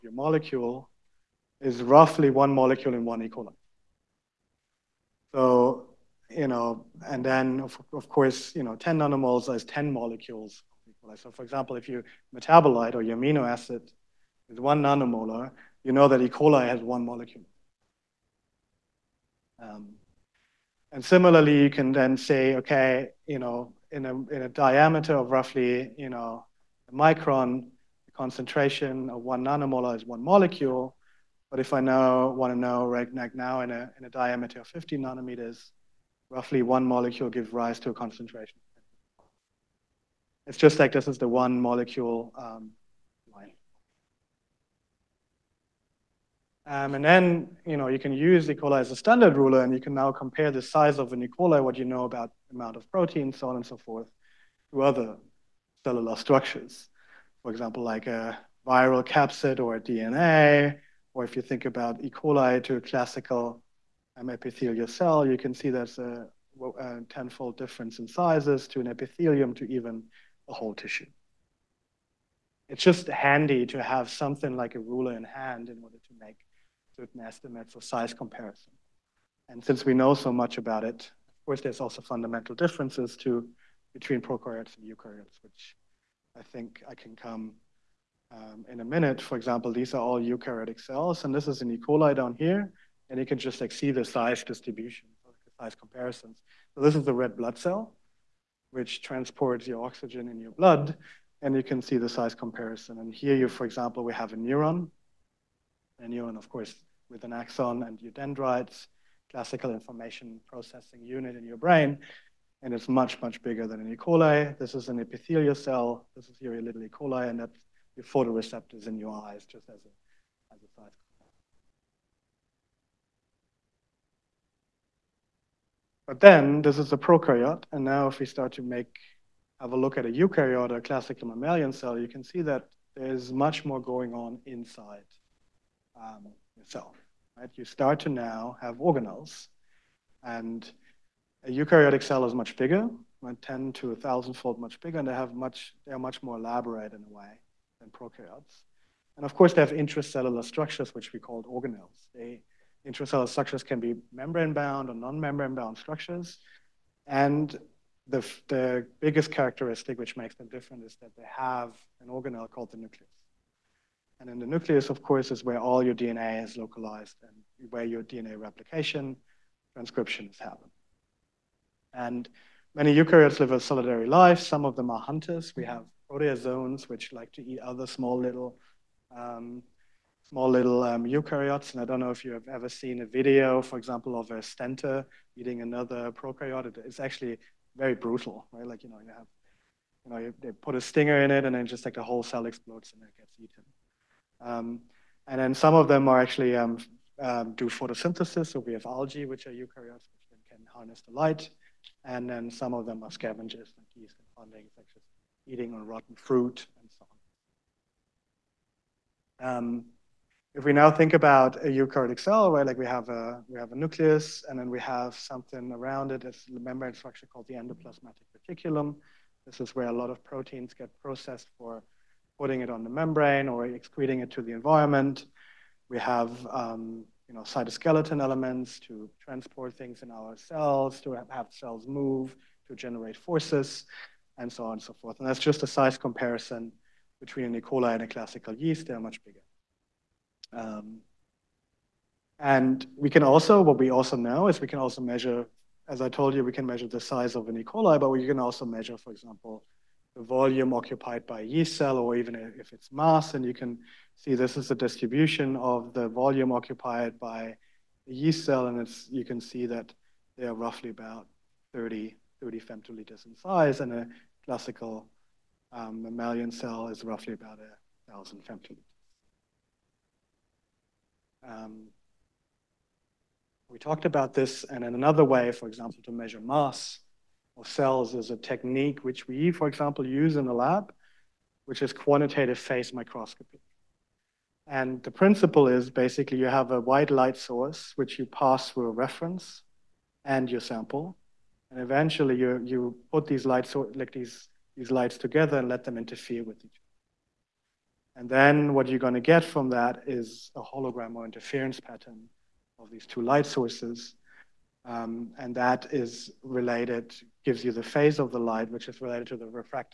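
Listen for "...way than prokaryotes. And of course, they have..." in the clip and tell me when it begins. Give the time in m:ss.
2:27.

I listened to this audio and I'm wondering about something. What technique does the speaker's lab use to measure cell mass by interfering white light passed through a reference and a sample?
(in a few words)
quantitative phase microscopy.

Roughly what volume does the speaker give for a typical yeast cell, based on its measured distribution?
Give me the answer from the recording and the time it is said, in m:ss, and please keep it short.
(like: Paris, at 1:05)
30 femtoliters, at 4:22.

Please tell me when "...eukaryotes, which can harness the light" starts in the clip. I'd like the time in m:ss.
3:19.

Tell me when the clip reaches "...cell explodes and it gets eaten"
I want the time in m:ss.
3:12.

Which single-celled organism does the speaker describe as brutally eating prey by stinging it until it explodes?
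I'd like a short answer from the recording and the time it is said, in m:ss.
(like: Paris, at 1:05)
stentor, at 3:04.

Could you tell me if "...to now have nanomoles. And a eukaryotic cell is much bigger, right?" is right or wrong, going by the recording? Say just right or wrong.
wrong.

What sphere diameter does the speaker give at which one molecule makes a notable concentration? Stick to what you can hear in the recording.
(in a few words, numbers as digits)
50 nanometers.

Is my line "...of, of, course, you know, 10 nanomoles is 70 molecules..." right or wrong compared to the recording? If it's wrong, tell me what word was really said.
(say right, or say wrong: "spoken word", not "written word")
wrong: "10", not "70".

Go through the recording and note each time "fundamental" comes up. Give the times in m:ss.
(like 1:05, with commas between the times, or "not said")
1:22.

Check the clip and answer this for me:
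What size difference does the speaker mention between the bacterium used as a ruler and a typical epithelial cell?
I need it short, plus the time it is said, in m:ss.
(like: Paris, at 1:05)
tenfold, at 1:07.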